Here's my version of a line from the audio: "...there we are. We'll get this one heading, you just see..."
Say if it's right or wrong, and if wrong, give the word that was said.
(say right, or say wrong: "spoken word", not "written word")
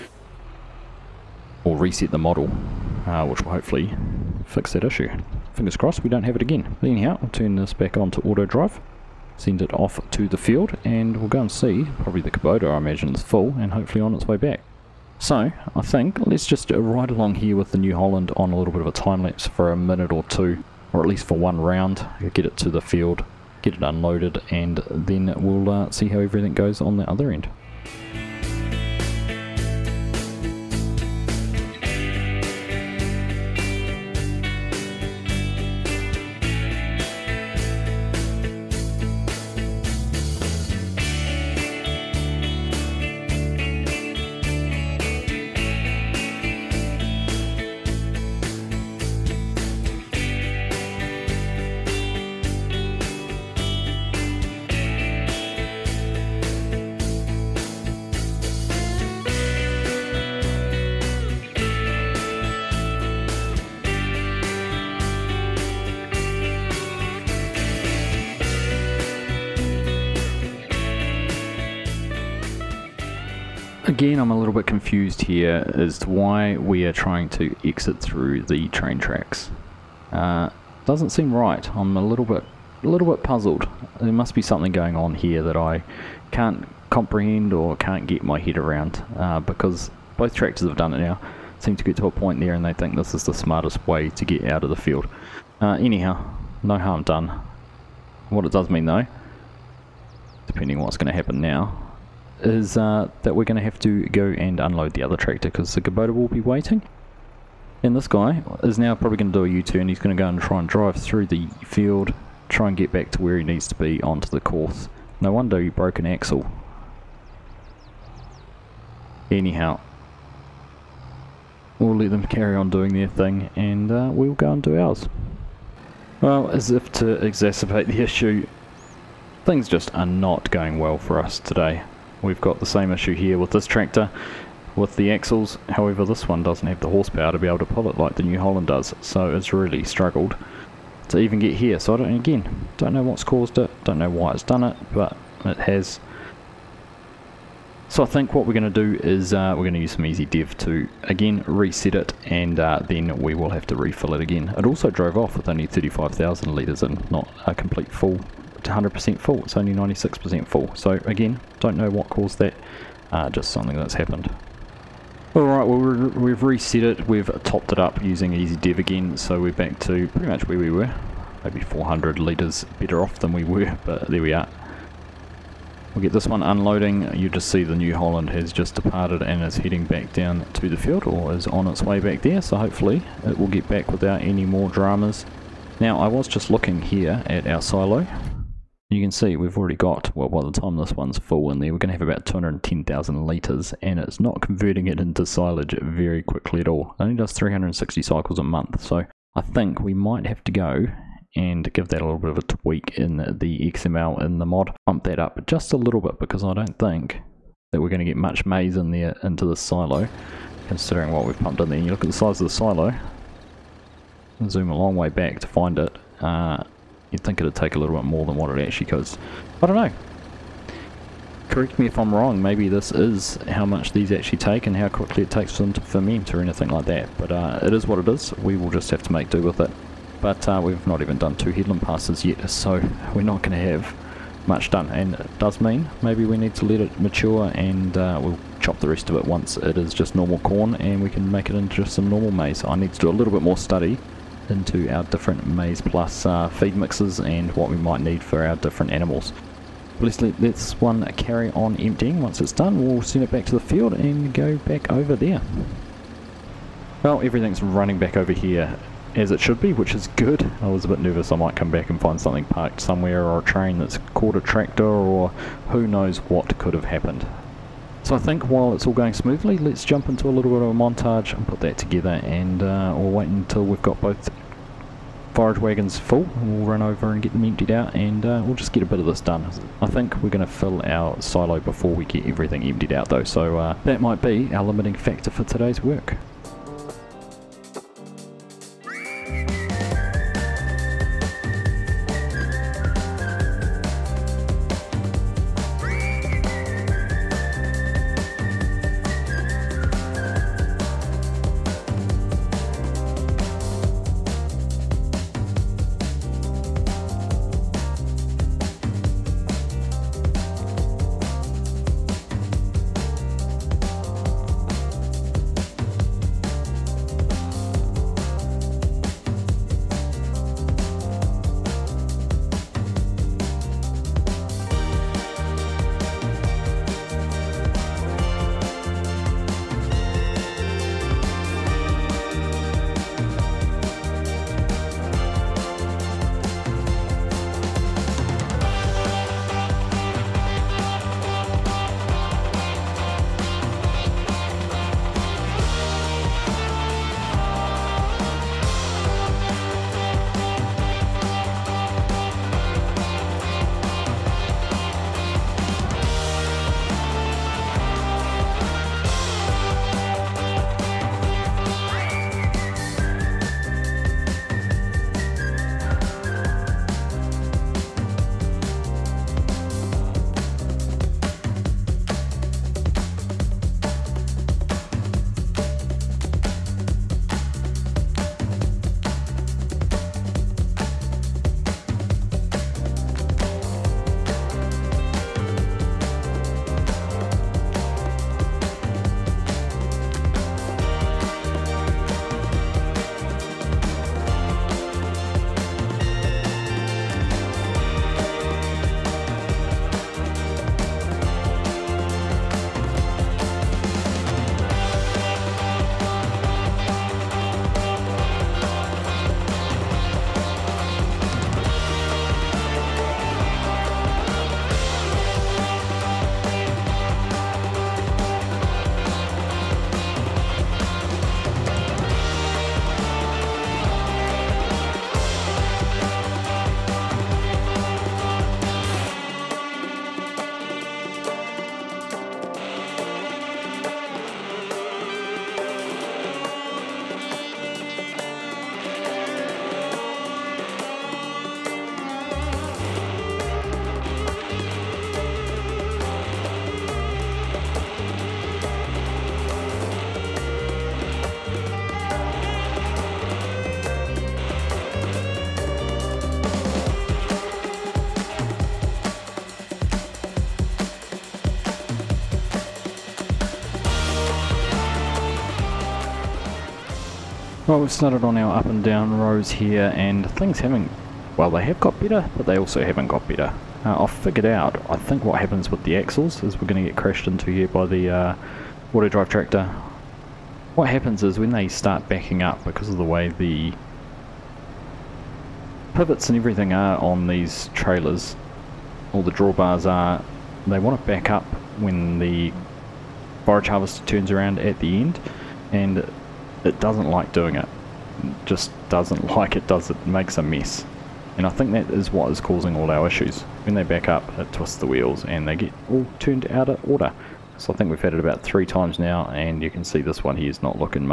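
wrong: "unloading", not "heading".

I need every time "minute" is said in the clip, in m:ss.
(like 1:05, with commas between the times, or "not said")
0:19.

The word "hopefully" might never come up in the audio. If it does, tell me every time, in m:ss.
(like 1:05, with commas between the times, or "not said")
0:03, 0:13, 3:02.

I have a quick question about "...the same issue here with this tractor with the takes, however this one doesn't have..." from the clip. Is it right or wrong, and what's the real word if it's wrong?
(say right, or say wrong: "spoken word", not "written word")
wrong: "axles", not "takes".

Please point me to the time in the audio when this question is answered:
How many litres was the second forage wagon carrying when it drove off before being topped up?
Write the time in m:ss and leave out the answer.
2:35.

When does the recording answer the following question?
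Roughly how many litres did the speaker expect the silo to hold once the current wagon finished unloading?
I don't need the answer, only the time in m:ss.
3:12.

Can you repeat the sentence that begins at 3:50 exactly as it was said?
But uh, we've not even done two headland passes yet, so we're not going to have much done.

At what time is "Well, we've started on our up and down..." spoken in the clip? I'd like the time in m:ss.
7:47.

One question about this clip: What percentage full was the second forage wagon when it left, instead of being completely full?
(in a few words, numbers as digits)
96%.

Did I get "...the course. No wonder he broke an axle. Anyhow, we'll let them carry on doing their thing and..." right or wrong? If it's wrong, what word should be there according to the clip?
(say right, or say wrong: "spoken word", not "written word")
right.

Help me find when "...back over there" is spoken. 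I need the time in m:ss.
4:14.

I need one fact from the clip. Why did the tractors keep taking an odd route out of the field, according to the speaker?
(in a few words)
The train tracks.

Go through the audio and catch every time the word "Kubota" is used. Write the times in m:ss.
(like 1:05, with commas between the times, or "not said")
0:12, 1:45.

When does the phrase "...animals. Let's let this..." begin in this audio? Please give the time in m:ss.
4:08.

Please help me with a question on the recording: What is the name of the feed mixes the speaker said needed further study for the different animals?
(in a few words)
Maize Plus.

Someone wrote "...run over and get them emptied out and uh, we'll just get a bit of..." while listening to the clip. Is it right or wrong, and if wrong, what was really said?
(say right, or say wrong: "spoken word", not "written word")
right.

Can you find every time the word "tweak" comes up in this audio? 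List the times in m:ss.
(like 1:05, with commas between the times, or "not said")
3:22.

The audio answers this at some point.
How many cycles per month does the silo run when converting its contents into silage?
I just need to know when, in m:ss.
3:17.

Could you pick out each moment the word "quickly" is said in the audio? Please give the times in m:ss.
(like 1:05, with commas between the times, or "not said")
3:16, 3:44.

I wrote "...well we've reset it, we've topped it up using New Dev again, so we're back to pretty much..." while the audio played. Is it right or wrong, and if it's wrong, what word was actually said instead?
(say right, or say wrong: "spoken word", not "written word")
wrong: "Easy", not "New".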